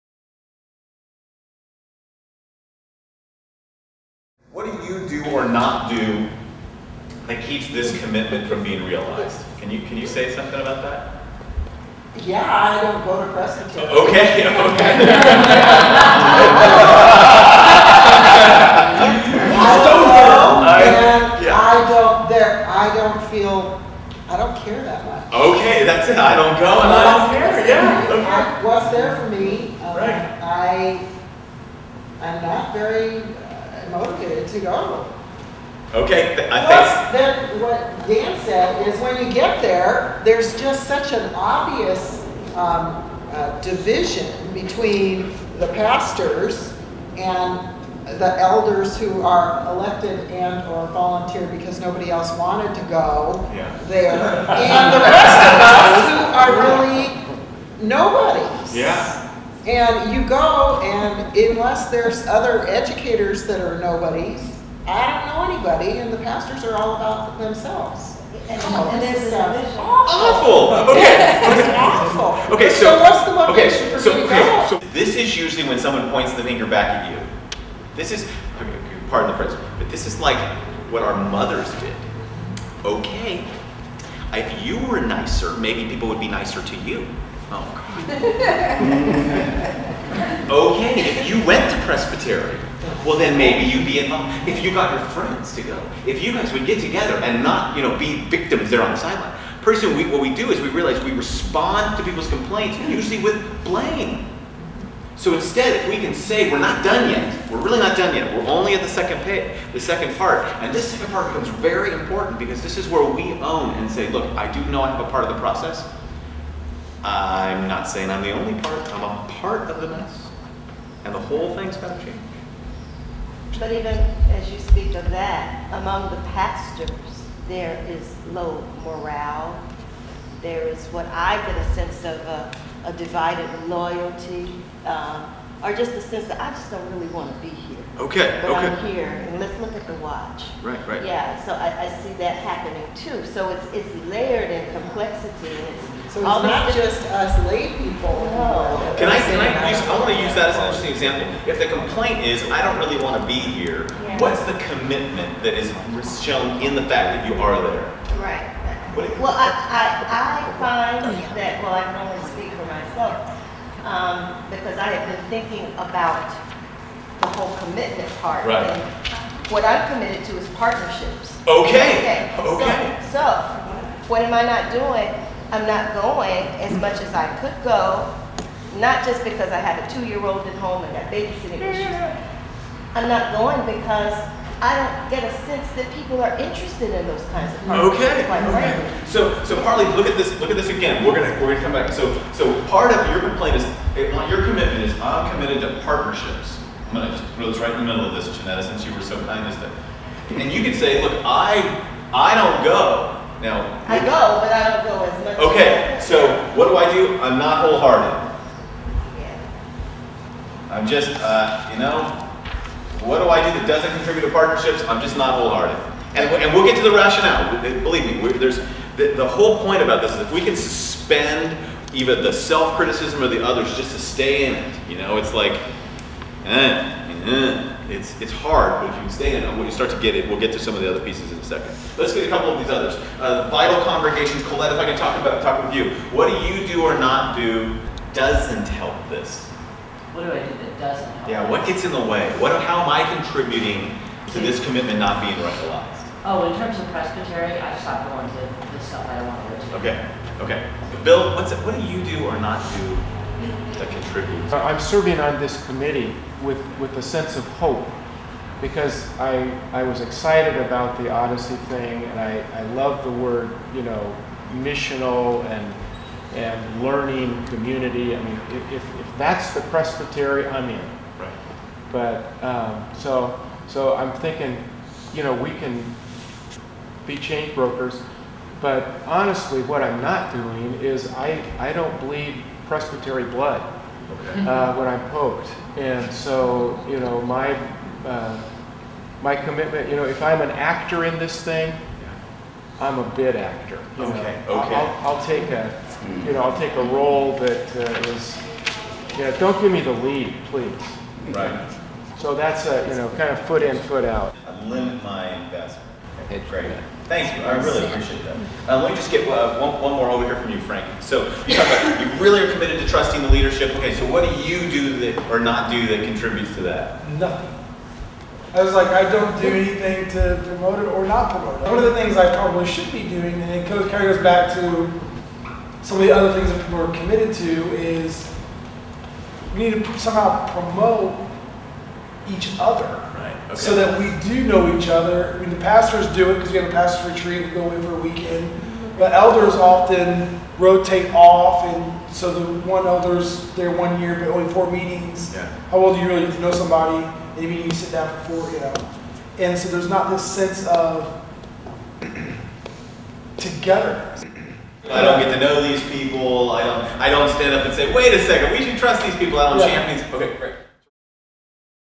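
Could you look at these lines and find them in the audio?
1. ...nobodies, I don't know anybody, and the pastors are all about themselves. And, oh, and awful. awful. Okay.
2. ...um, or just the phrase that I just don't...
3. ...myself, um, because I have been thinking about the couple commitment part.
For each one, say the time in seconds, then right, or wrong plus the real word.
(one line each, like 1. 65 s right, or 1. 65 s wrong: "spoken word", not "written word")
1. 63 s right
2. 134 s wrong: "sense", not "phrase"
3. 162 s wrong: "whole", not "couple".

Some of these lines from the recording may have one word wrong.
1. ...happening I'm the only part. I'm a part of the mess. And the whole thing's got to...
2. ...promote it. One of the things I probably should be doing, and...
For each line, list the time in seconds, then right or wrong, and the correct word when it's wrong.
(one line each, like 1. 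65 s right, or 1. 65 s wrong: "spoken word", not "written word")
1. 117 s wrong: "saying", not "happening"
2. 321 s right.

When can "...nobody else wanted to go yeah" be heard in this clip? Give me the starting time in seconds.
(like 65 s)
51 s.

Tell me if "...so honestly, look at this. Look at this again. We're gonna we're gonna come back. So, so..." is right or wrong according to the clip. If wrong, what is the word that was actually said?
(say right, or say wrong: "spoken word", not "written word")
wrong: "partly", not "honestly".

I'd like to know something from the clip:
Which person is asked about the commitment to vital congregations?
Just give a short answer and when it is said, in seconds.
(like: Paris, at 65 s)
Colette, at 234 s.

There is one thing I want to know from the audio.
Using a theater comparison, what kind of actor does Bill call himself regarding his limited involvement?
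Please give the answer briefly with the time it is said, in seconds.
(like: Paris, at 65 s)
a bit actor, at 293 s.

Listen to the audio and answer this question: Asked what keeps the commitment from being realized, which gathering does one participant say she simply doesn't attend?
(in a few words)
Crescent.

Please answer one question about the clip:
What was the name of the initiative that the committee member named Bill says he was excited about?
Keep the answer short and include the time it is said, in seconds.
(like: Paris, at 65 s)
Odyssey, at 261 s.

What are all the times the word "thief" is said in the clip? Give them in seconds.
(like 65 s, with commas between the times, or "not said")
not said.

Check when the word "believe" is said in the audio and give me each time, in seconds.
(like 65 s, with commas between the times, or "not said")
217 s, 281 s.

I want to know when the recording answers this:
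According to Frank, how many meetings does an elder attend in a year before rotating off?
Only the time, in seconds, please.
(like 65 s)
344 s.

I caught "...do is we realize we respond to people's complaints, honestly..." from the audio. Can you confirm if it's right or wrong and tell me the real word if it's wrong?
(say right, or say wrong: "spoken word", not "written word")
wrong: "usually", not "honestly".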